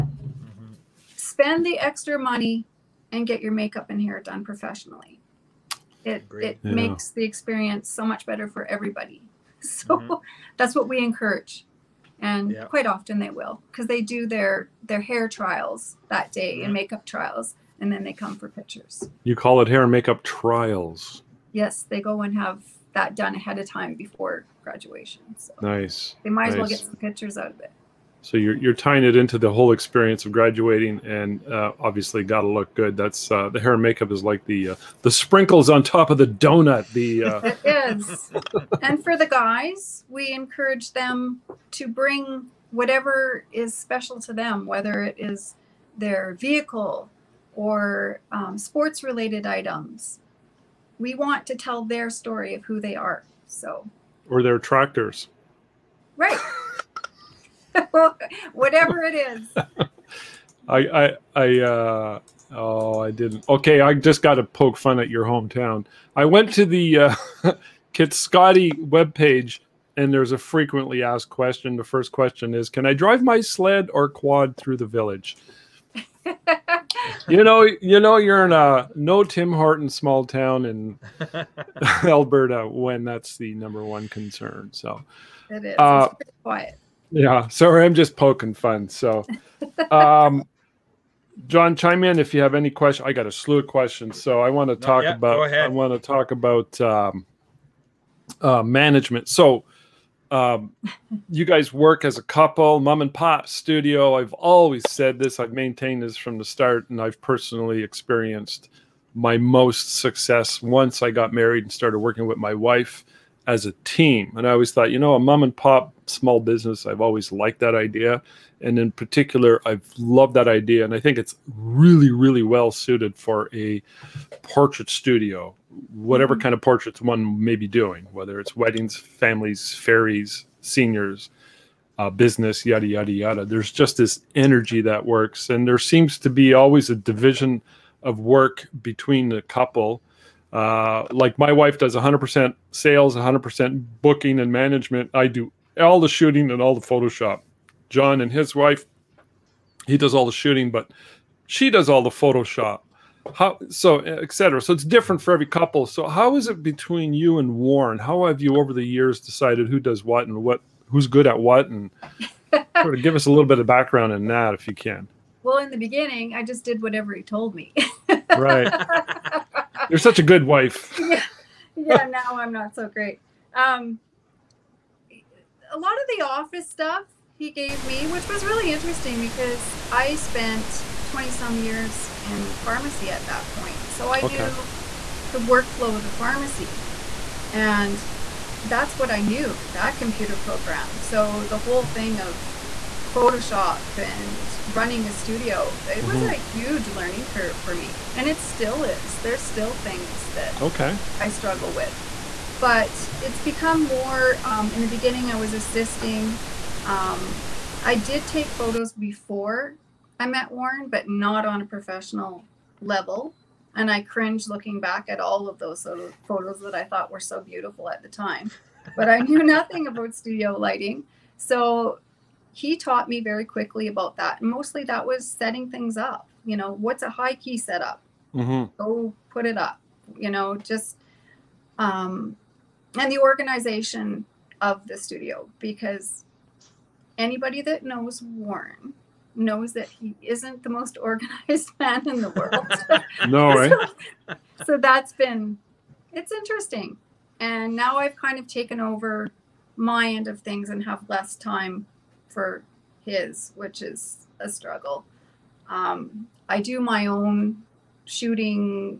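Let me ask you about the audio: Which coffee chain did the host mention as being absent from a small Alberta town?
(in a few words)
Tim Horton.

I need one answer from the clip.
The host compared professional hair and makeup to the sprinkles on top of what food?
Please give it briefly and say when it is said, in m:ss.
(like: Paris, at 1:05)
donut, at 0:36.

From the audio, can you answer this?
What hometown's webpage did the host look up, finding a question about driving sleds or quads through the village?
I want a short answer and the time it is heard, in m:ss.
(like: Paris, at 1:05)
Kitscoty, at 1:07.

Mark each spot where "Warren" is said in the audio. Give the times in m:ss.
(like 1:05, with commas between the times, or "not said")
2:37, 3:30, 3:58.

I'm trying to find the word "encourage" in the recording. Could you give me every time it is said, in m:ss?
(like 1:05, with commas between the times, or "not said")
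0:10, 0:40.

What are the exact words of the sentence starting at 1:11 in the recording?
The first question is Can I drive my sled or quad through the village?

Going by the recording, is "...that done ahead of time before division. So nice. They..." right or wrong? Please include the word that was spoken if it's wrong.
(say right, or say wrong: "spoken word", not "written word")
wrong: "graduation", not "division".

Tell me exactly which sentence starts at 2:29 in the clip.
He does all the shooting, but she does all the Photoshop.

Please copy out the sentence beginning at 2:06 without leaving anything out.
kind of portraits one may be doing, whether it's weddings, families, fairies, seniors, uh, business, yada, yada, yada.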